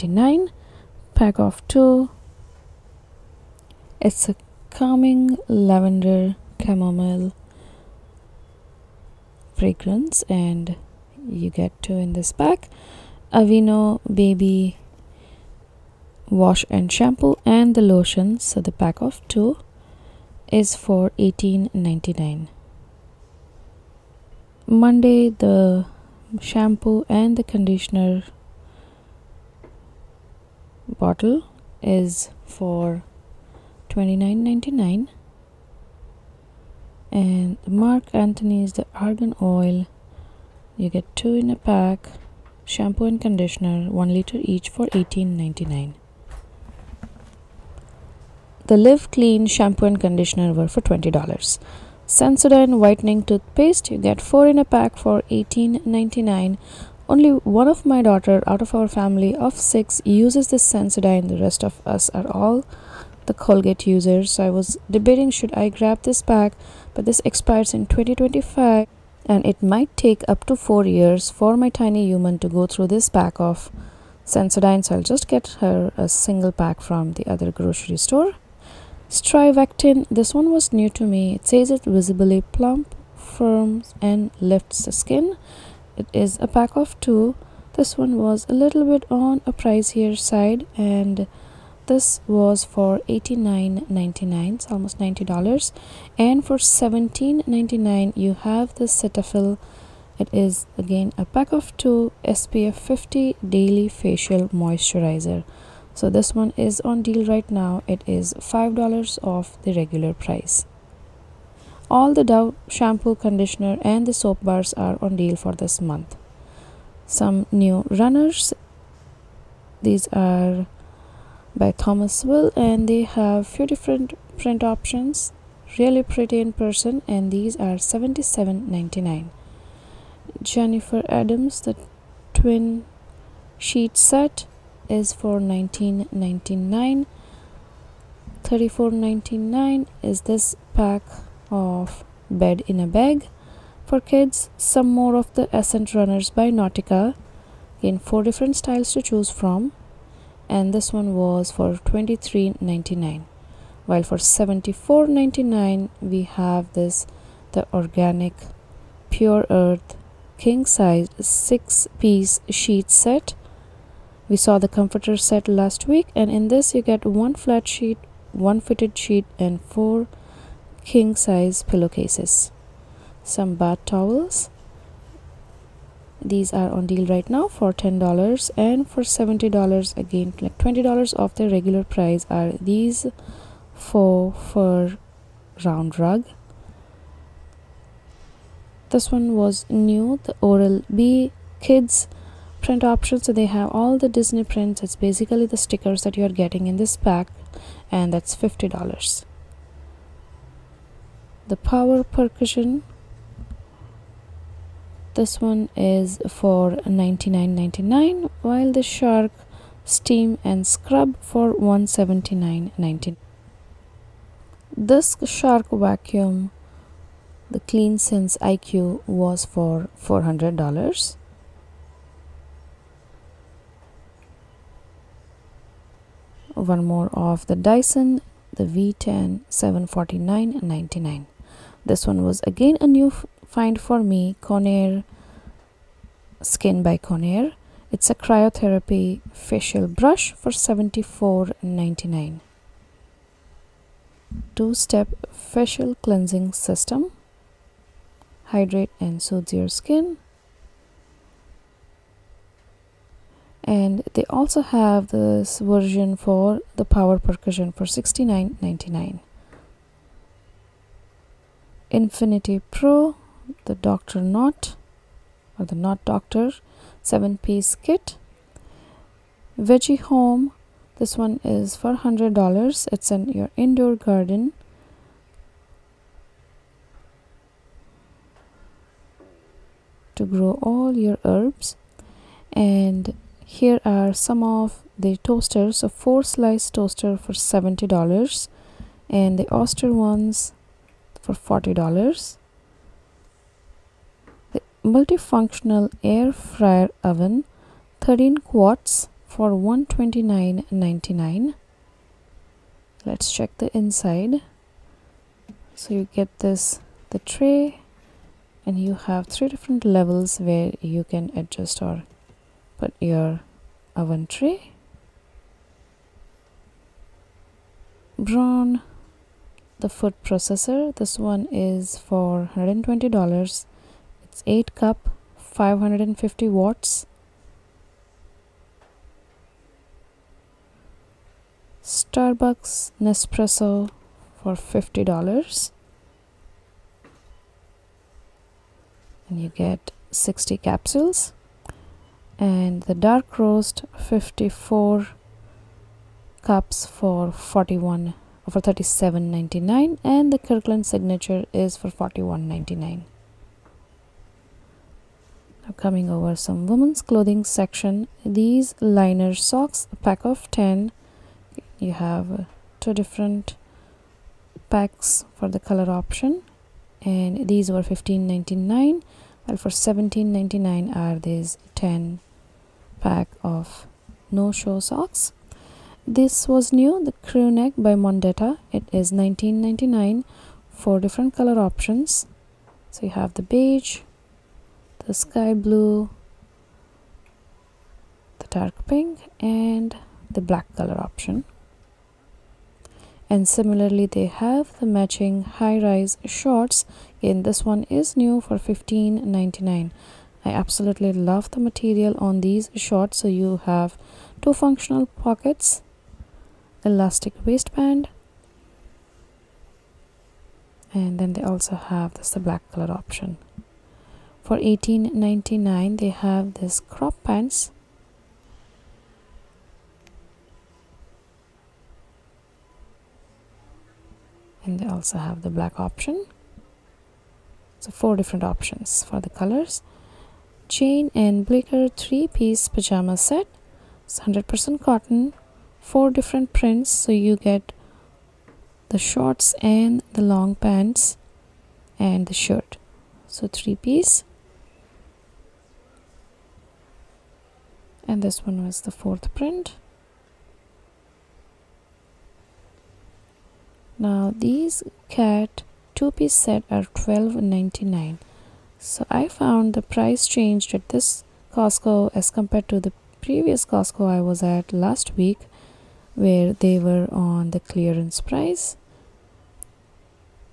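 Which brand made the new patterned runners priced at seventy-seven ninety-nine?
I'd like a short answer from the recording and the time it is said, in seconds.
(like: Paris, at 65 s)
Thomas Will, at 121 s.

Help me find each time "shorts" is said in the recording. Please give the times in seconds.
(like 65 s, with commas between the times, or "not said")
396 s, 402 s, 438 s.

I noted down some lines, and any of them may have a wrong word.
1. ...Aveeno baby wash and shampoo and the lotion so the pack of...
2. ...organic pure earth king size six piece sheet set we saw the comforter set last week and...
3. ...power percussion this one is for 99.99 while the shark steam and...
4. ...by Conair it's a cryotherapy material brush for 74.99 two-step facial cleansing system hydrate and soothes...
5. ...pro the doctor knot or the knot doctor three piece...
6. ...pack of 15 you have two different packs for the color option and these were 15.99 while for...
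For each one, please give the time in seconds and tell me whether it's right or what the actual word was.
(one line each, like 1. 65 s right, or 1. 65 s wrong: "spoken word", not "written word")
1. 13 s right
2. 157 s right
3. 201 s right
4. 236 s wrong: "facial", not "material"
5. 262 s wrong: "seven", not "three"
6. 360 s wrong: "10", not "15".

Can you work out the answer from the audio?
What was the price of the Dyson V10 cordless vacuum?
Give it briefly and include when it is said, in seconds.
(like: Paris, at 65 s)
$749.99, at 229 s.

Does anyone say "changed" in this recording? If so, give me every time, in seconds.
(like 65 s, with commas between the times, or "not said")
460 s.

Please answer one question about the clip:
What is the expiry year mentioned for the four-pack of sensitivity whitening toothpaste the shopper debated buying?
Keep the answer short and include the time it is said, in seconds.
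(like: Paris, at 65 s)
2025, at 67 s.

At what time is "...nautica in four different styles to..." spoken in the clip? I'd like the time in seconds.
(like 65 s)
146 s.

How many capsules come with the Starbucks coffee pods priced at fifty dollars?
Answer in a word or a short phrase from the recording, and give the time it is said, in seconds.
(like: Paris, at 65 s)
60, at 340 s.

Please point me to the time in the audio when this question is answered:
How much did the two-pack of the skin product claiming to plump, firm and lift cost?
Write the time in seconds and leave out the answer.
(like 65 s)
93 s.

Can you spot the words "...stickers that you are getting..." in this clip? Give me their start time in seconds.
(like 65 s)
195 s.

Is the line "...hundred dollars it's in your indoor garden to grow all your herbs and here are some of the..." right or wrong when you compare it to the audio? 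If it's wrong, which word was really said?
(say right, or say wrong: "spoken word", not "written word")
right.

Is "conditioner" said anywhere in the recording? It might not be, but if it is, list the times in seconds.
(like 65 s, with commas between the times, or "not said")
27 s, 43 s, 50 s, 113 s.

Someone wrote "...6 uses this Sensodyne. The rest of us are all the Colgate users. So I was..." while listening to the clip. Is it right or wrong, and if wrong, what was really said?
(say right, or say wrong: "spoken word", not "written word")
right.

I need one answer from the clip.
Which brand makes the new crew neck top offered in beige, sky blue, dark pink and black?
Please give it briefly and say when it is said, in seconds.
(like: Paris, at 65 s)
Mondetta, at 377 s.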